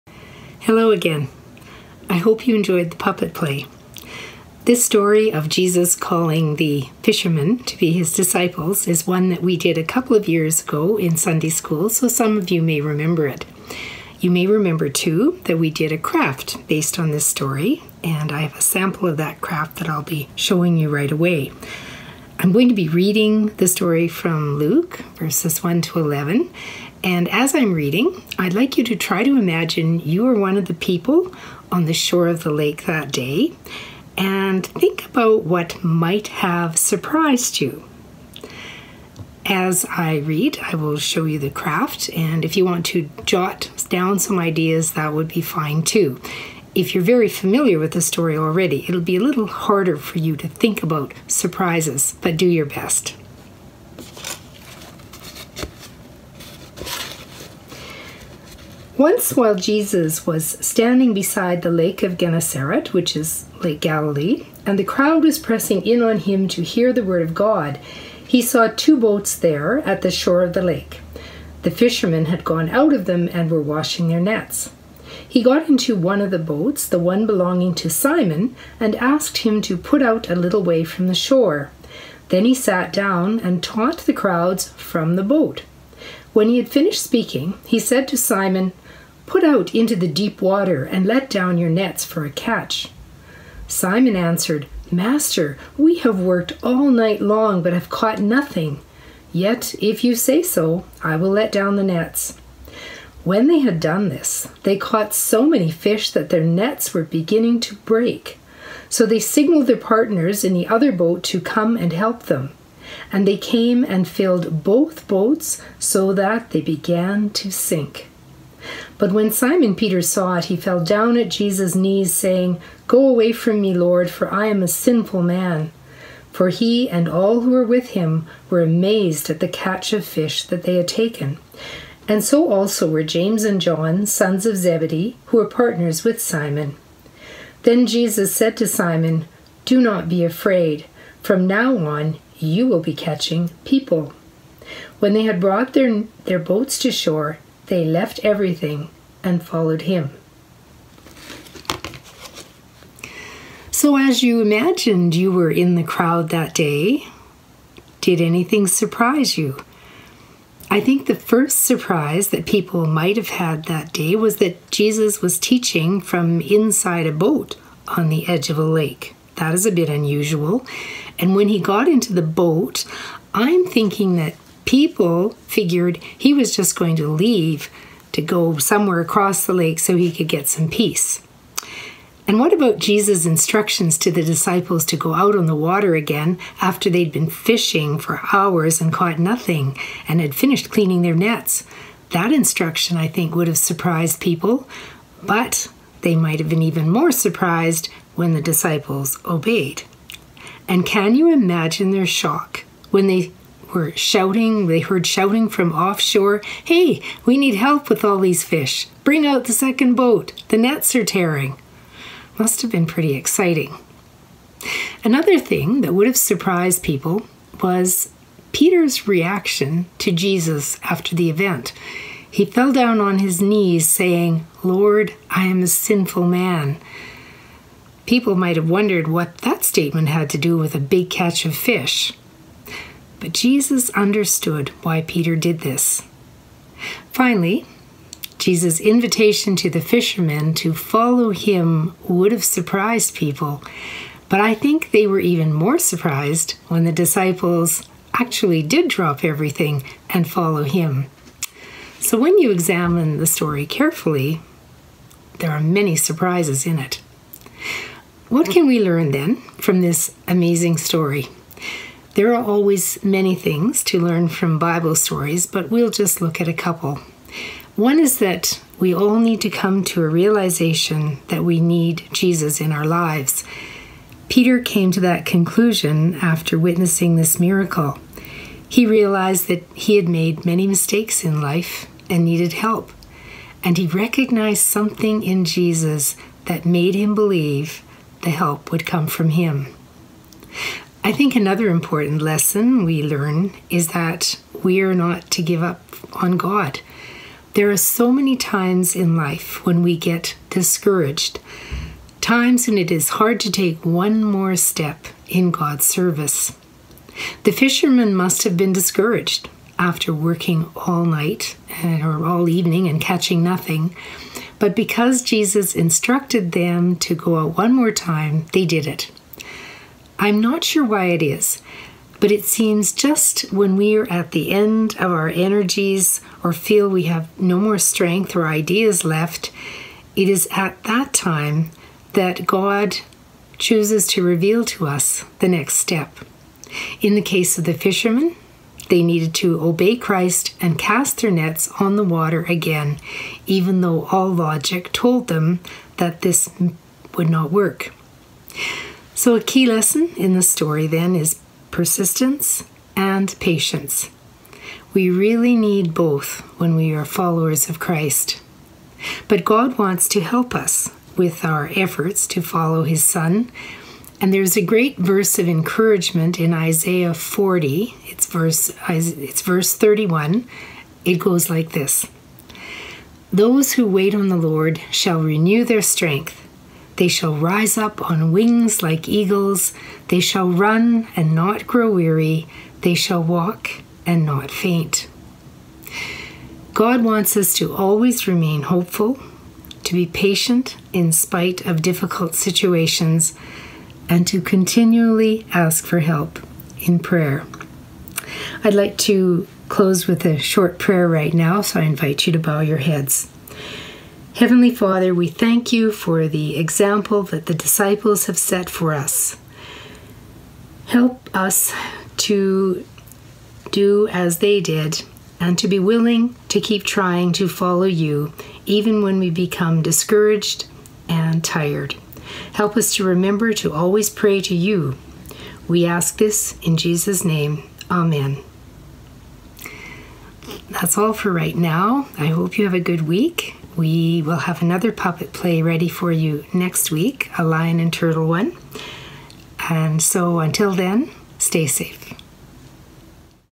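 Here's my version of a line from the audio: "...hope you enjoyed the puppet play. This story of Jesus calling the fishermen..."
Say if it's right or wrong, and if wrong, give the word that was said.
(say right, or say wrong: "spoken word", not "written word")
right.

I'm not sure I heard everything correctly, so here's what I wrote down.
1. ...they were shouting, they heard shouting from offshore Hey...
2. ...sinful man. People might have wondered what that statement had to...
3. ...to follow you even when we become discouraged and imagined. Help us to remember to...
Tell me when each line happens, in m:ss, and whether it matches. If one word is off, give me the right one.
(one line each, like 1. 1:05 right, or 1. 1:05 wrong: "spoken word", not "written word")
1. 3:23 right
2. 3:45 right
3. 6:57 wrong: "tired", not "imagined".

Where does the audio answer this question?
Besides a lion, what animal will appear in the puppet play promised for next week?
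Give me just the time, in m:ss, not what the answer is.
7:17.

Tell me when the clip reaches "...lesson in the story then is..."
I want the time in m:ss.
5:49.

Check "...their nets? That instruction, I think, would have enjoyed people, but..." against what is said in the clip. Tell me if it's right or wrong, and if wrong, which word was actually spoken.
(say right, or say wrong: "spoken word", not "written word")
wrong: "surprised", not "enjoyed".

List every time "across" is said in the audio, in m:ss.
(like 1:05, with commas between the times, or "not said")
2:59.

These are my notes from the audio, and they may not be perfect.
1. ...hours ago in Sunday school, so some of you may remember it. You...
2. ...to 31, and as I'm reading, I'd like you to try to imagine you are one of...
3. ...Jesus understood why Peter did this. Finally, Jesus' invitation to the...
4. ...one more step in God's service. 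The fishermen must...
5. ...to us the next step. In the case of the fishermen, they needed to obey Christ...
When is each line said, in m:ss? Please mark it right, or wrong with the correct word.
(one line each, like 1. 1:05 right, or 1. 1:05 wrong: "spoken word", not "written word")
1. 0:10 wrong: "years", not "hours"
2. 0:25 wrong: "11", not "31"
3. 3:53 right
4. 5:03 right
5. 5:34 right.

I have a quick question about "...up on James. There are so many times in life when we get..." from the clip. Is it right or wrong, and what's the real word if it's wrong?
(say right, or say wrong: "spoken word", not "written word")
wrong: "God", not "James".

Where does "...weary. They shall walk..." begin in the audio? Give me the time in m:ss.
6:21.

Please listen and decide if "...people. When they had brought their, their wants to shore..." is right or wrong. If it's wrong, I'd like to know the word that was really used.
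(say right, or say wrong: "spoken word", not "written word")
wrong: "boats", not "wants".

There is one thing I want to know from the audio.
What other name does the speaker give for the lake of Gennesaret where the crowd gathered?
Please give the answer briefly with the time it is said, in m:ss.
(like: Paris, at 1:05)
Lake Galilee, at 1:03.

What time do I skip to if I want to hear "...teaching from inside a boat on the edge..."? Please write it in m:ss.
2:45.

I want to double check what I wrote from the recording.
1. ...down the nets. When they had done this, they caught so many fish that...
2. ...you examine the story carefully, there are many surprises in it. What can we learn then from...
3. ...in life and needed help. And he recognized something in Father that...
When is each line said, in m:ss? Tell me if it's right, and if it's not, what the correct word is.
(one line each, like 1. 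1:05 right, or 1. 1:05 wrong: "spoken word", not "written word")
1. 1:41 right
2. 4:12 right
3. 4:41 wrong: "Jesus", not "Father".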